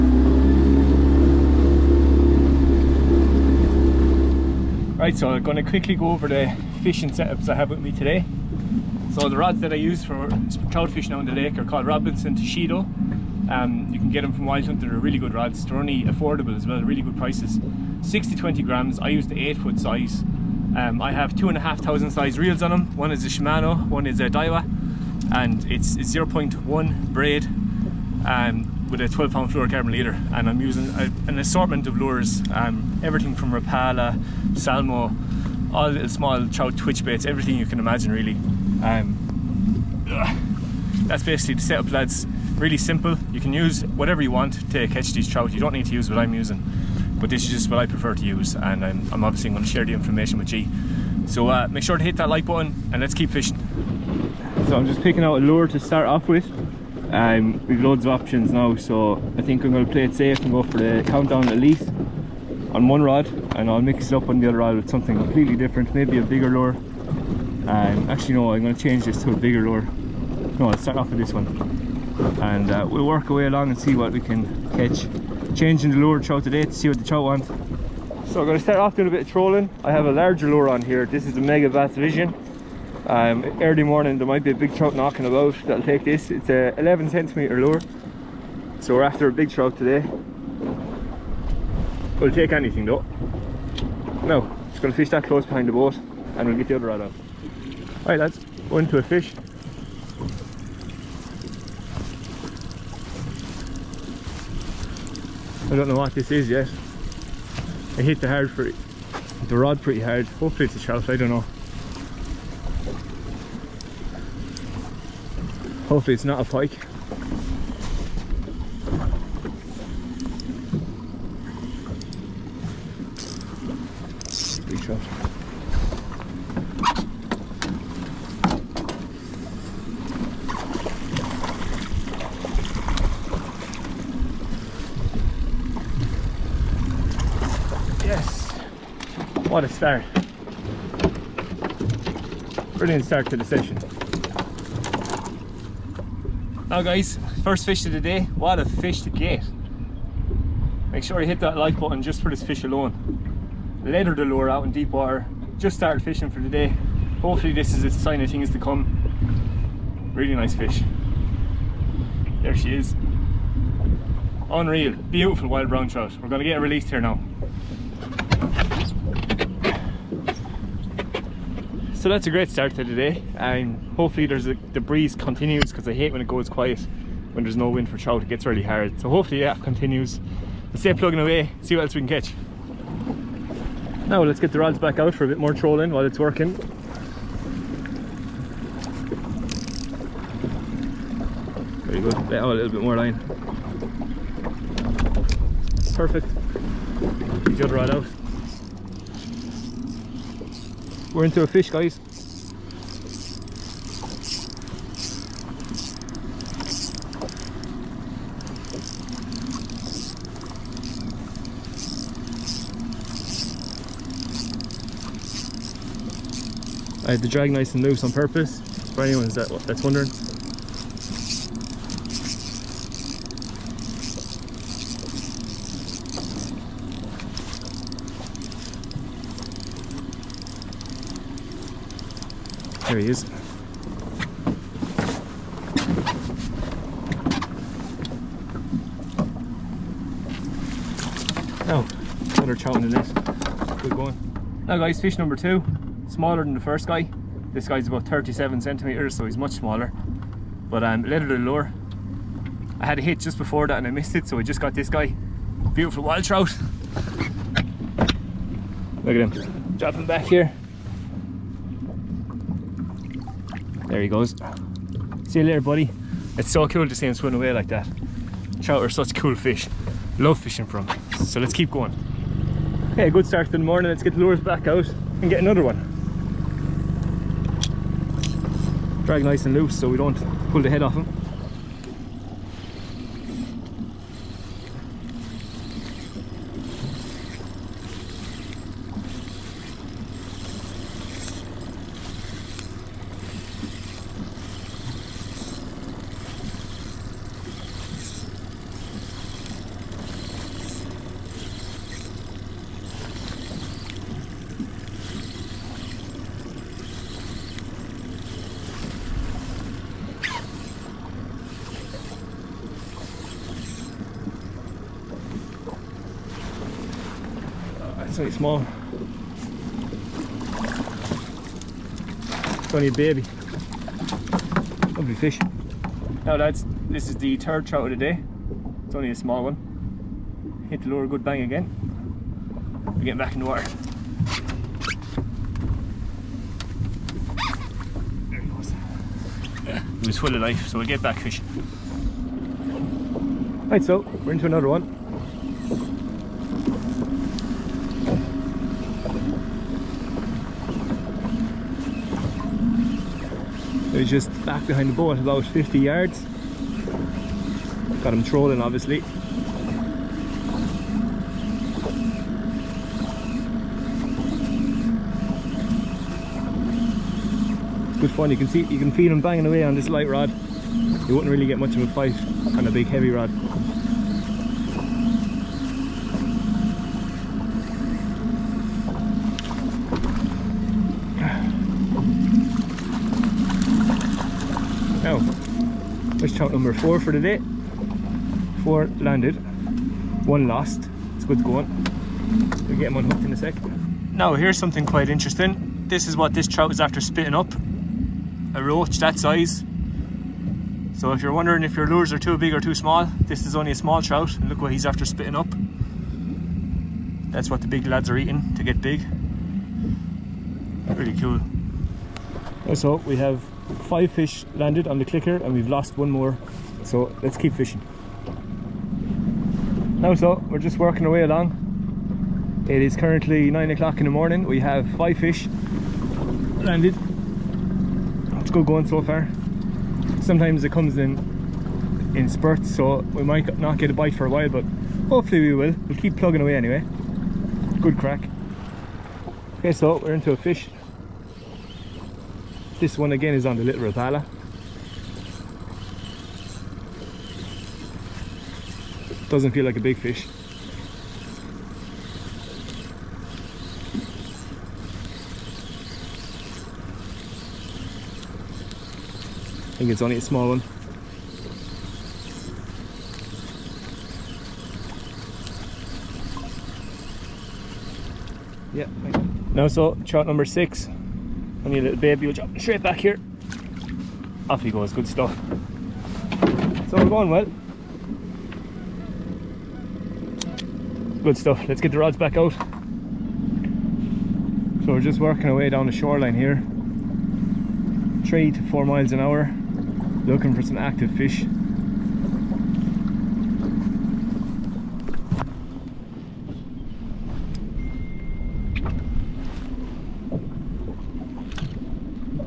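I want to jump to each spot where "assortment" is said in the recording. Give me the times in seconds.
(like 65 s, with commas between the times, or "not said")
31 s.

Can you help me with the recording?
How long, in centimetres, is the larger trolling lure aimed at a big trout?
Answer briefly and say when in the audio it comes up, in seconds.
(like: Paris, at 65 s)
11 centimetres, at 86 s.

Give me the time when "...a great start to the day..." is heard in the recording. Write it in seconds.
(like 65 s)
172 s.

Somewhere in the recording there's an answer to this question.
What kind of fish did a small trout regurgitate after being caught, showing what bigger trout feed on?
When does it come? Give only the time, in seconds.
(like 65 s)
398 s.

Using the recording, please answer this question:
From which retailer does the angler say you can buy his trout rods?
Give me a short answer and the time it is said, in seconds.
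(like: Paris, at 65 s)
Wild Hunter, at 14 s.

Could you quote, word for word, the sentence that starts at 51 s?
So uh, make sure to hit that like button and let's keep fishing.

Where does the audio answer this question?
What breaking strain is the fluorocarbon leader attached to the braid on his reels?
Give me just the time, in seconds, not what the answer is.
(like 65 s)
29 s.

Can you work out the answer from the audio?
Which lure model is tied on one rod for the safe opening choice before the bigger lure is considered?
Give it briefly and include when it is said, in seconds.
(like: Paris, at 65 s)
countdown elite, at 61 s.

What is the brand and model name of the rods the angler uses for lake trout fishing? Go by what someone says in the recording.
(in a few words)
Robinson Toshido.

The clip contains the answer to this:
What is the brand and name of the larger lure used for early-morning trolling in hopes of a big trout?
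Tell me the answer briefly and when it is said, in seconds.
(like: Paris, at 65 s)
Megabass Vision, at 81 s.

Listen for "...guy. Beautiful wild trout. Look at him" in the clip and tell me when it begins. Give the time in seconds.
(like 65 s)
254 s.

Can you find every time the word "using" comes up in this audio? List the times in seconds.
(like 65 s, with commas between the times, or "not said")
30 s, 46 s.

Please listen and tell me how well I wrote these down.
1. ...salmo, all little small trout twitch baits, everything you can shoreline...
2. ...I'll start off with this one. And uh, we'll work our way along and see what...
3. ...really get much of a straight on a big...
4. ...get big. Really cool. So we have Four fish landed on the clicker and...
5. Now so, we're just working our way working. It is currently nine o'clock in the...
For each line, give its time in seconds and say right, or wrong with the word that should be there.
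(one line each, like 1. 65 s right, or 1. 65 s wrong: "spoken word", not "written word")
1. 34 s wrong: "imagine", not "shoreline"
2. 70 s right
3. 371 s wrong: "fight", not "straight"
4. 408 s wrong: "Five", not "Four"
5. 419 s wrong: "along", not "working".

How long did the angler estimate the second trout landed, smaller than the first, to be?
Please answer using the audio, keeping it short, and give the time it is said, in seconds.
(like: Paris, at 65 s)
37 centimetres, at 248 s.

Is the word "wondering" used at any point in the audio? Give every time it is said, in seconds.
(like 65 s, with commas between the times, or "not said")
219 s, 401 s.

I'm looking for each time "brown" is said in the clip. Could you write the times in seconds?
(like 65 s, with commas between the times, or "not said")
165 s.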